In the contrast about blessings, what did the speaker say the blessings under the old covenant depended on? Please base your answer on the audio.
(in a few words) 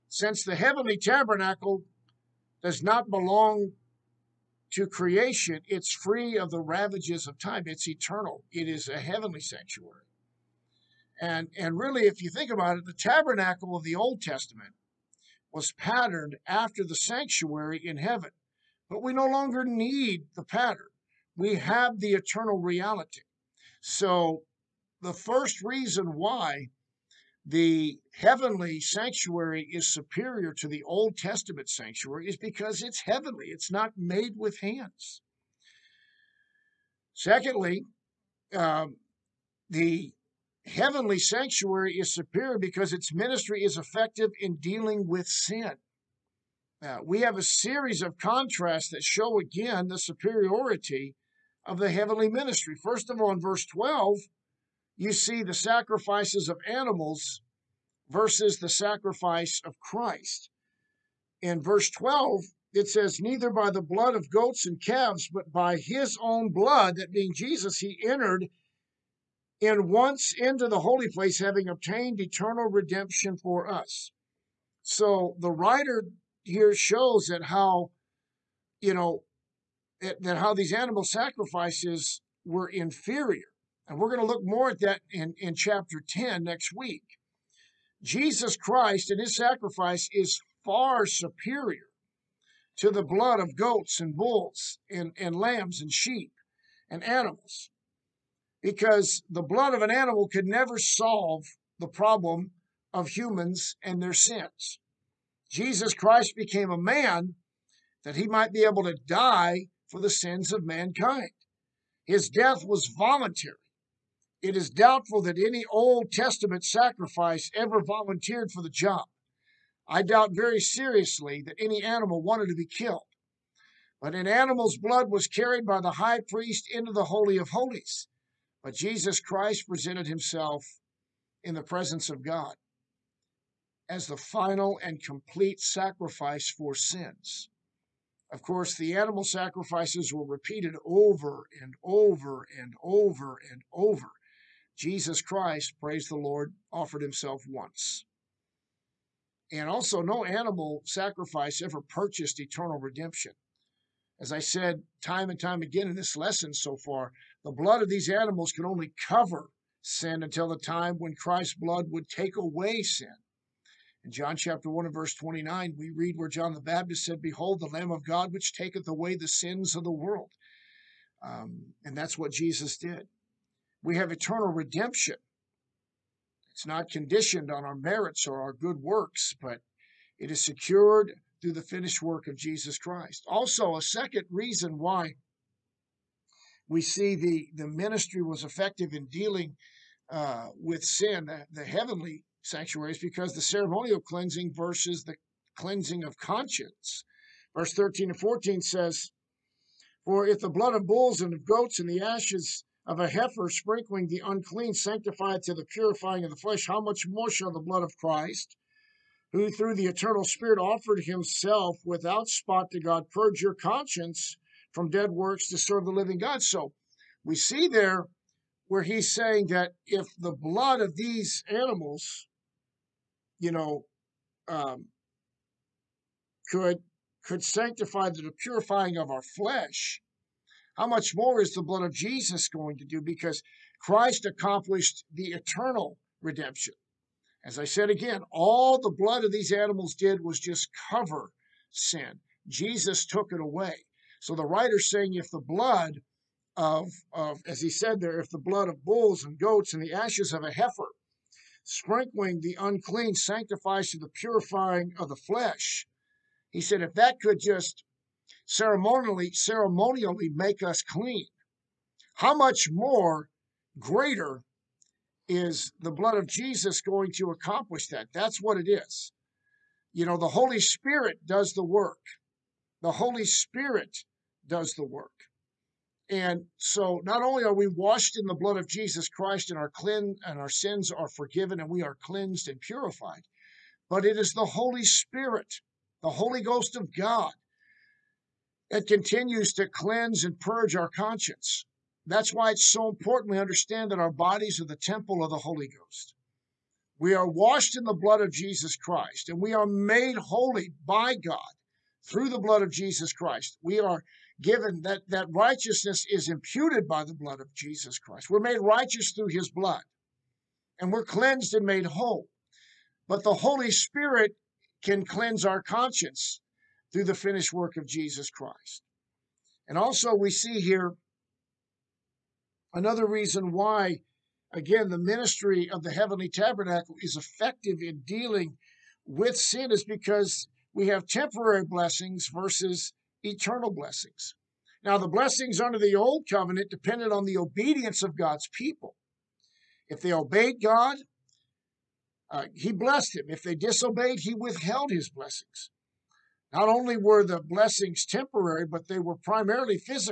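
Obedience of God's people.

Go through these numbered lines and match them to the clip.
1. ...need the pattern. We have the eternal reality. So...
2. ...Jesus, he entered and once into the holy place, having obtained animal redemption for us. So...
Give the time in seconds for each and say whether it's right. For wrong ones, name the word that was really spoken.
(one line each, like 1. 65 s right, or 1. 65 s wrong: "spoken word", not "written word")
1. 19 s right
2. 67 s wrong: "eternal", not "animal".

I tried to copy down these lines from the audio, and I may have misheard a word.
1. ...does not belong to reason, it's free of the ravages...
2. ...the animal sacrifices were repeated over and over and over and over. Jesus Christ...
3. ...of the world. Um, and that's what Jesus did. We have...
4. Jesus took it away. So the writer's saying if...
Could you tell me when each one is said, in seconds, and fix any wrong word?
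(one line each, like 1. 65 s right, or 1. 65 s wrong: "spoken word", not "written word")
1. 2 s wrong: "creation", not "reason"
2. 138 s right
3. 169 s right
4. 242 s right.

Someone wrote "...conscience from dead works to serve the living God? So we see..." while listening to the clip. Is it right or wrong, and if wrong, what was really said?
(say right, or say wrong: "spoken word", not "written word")
right.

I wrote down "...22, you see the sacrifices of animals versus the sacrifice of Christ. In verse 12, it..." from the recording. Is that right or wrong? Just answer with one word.
wrong.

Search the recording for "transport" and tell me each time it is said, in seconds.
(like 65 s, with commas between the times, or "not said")
not said.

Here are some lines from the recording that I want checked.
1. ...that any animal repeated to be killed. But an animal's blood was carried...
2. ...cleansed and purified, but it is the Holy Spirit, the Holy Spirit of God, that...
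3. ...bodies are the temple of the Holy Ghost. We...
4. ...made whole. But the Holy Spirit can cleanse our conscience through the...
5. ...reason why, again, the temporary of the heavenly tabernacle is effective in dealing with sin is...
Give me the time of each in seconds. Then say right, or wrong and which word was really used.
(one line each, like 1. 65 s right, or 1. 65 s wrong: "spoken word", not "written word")
1. 121 s wrong: "wanted", not "repeated"
2. 282 s wrong: "Ghost", not "Spirit"
3. 294 s right
4. 311 s right
5. 323 s wrong: "ministry", not "temporary".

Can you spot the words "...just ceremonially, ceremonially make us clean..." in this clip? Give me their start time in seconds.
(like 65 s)
257 s.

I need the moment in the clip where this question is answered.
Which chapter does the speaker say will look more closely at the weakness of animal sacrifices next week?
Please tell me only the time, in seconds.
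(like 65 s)
85 s.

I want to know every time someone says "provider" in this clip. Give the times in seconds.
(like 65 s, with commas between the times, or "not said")
not said.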